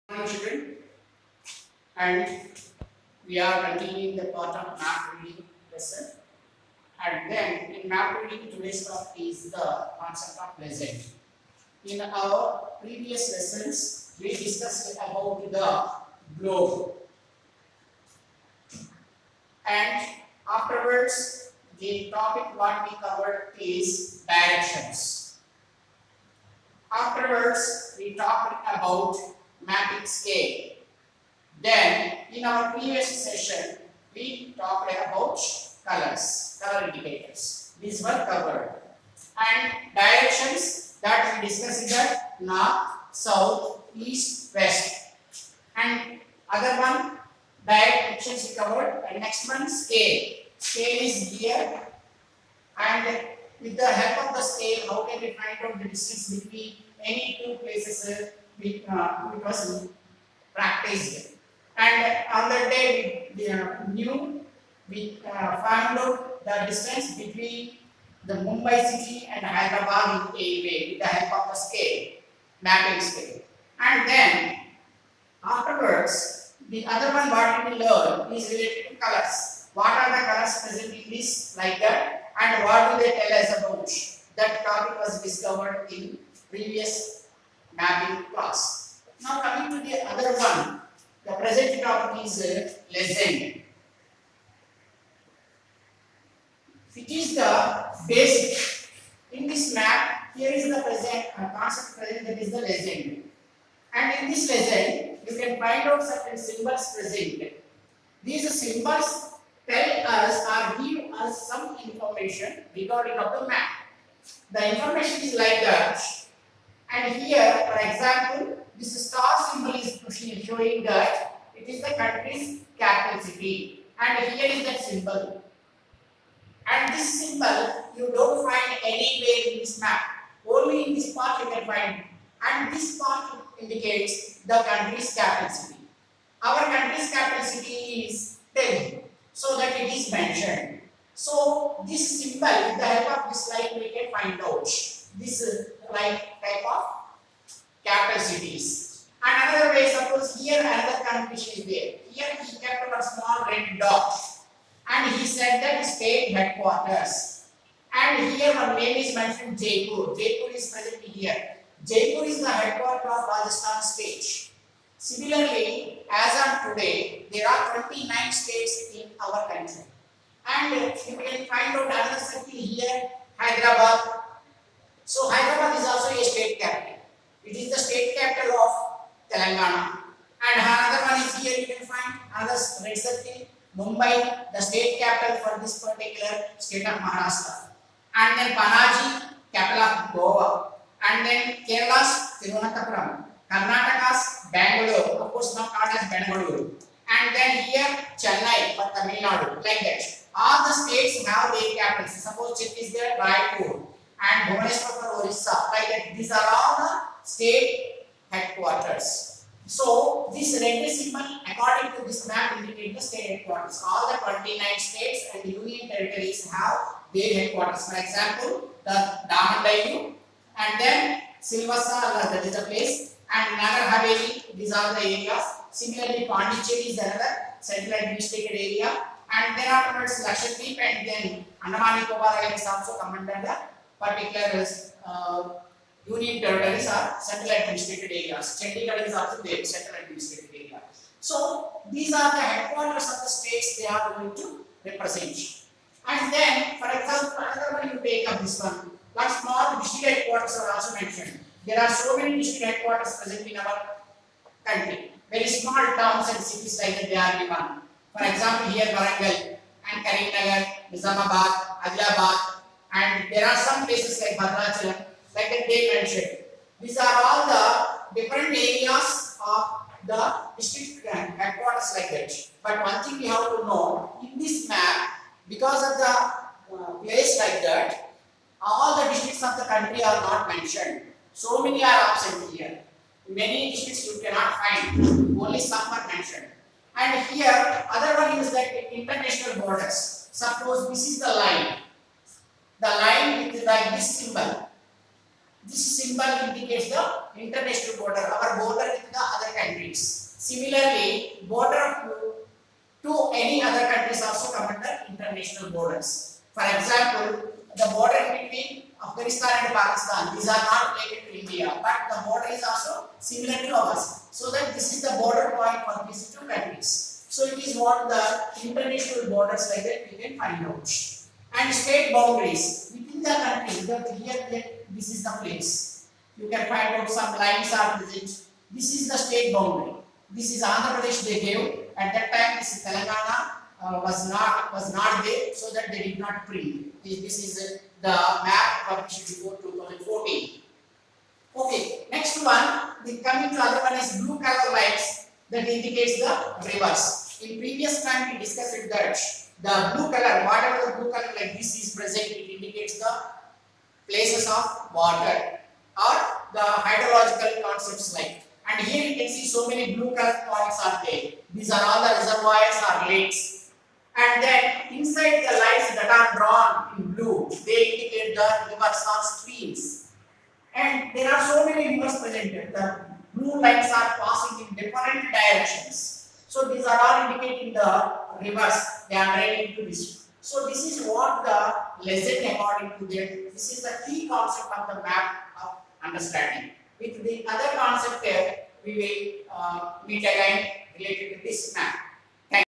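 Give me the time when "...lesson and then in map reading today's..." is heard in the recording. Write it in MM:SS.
00:05.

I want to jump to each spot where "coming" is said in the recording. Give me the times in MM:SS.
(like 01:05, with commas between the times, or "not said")
01:29, 05:43.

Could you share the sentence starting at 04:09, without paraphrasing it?
Like small district headquarters are also mentioned.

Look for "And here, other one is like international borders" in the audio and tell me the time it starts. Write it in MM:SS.
04:46.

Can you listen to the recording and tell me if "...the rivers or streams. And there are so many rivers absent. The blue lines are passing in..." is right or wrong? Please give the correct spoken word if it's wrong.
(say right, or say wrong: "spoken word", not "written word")
wrong: "present", not "absent".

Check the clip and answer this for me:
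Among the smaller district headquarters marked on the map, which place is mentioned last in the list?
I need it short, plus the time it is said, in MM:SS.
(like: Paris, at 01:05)
Bhadrachalam, at 04:24.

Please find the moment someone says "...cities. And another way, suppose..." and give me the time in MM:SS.
02:28.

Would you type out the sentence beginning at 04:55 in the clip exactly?
This symbol indicates the international border, our border with the other countries.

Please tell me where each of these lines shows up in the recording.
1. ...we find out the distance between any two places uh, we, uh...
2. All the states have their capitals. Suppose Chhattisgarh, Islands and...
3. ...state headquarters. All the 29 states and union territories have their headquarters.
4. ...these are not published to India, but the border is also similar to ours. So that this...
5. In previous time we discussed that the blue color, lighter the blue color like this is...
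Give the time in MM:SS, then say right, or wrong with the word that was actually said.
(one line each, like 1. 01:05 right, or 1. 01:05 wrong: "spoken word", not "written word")
1. 00:55 right
2. 03:20 wrong: "Raipur", not "Islands"
3. 03:33 right
4. 05:10 wrong: "related", not "published"
5. 05:47 wrong: "whatever", not "lighter".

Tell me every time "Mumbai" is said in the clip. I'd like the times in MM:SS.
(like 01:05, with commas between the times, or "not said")
01:08, 03:04.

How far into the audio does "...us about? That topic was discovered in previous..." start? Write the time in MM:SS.
01:23.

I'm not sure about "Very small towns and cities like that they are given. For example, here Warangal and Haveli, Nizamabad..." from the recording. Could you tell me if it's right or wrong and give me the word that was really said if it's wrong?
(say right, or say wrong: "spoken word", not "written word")
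wrong: "Karimnagar", not "Haveli".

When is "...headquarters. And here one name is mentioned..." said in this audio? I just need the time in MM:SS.
02:36.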